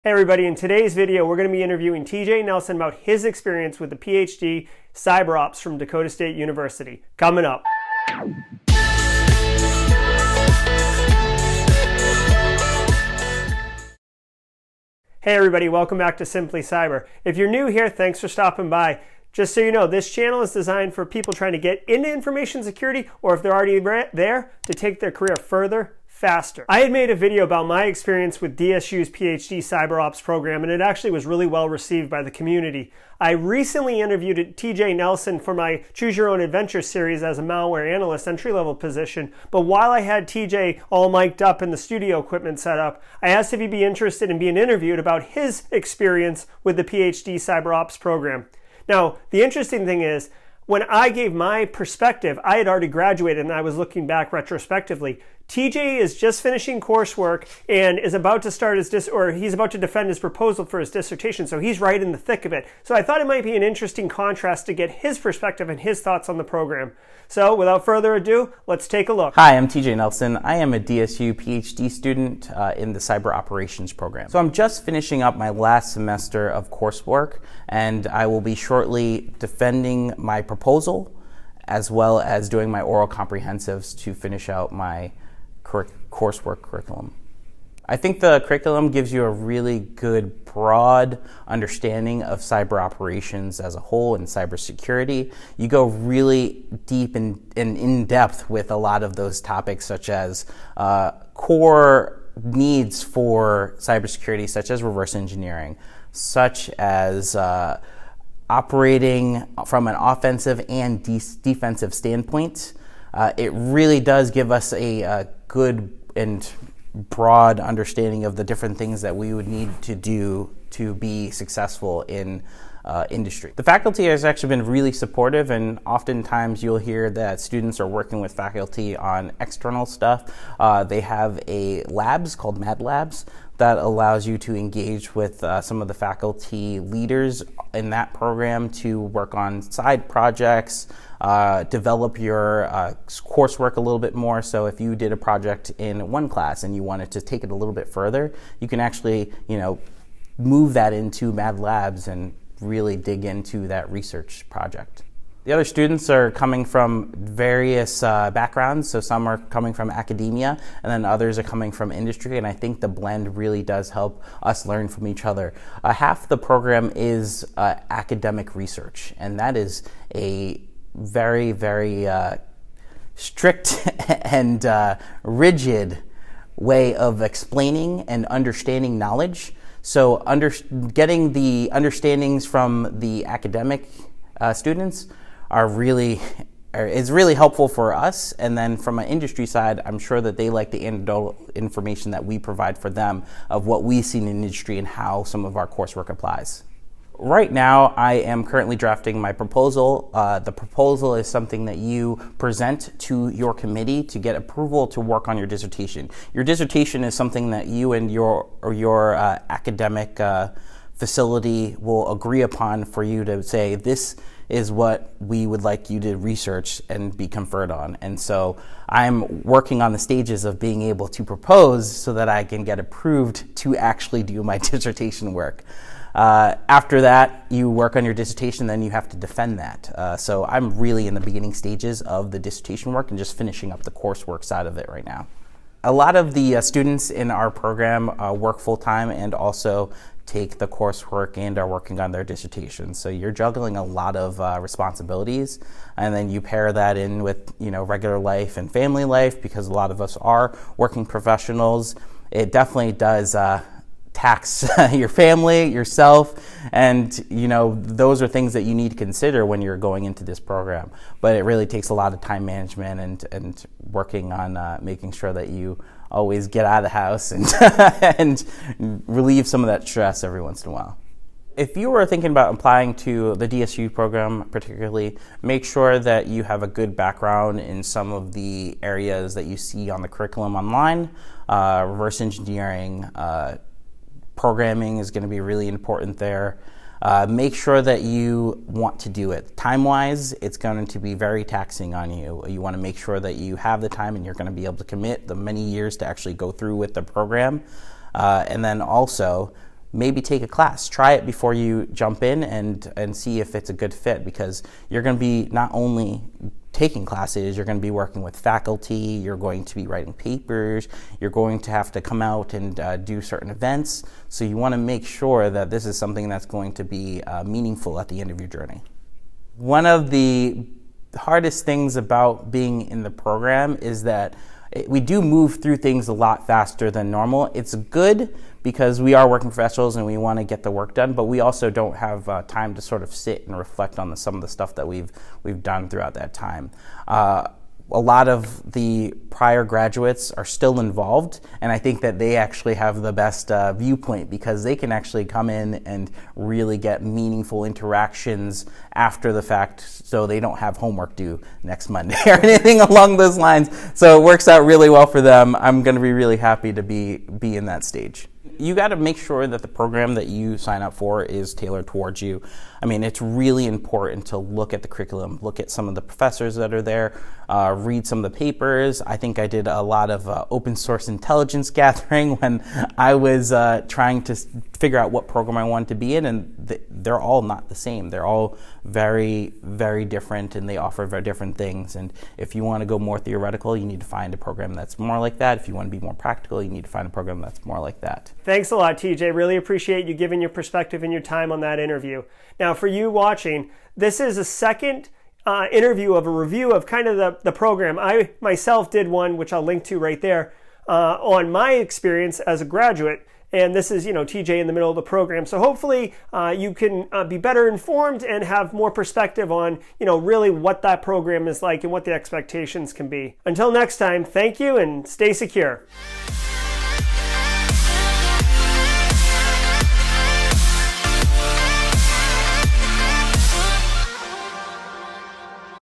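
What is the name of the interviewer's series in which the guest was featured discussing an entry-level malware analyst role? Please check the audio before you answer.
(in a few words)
Choose Your Own Adventure.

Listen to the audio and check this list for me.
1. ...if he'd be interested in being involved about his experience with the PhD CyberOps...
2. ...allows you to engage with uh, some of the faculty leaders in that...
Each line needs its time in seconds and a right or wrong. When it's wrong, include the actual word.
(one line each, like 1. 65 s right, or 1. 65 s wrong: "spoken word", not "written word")
1. 43 s wrong: "interviewed", not "involved"
2. 133 s right.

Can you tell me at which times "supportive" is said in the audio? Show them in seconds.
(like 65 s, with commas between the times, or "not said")
124 s.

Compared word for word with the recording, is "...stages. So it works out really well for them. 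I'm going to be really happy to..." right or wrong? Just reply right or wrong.
wrong.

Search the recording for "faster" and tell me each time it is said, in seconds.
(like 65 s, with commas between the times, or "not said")
26 s, 326 s.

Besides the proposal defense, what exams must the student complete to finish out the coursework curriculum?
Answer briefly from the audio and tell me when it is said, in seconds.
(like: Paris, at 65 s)
Oral comprehensives, at 82 s.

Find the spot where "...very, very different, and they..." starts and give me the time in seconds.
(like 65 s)
378 s.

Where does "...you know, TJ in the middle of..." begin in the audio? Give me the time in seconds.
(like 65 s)
404 s.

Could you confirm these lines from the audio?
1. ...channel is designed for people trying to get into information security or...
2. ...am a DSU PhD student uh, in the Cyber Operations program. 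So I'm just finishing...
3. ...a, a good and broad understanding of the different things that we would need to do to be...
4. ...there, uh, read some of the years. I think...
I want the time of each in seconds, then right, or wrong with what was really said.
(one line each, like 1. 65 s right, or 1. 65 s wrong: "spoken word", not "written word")
1. 20 s right
2. 70 s right
3. 114 s right
4. 366 s wrong: "papers", not "years".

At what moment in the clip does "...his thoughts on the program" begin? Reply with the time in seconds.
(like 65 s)
65 s.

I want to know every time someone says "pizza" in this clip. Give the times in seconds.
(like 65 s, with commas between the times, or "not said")
not said.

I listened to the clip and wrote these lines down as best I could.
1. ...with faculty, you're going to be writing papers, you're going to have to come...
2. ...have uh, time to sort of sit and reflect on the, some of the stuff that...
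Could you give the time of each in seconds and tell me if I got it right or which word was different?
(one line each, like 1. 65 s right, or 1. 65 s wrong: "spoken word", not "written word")
1. 308 s right
2. 331 s right.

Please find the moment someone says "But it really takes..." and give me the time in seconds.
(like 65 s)
261 s.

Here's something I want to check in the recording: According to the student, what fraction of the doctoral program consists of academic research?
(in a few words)
Half.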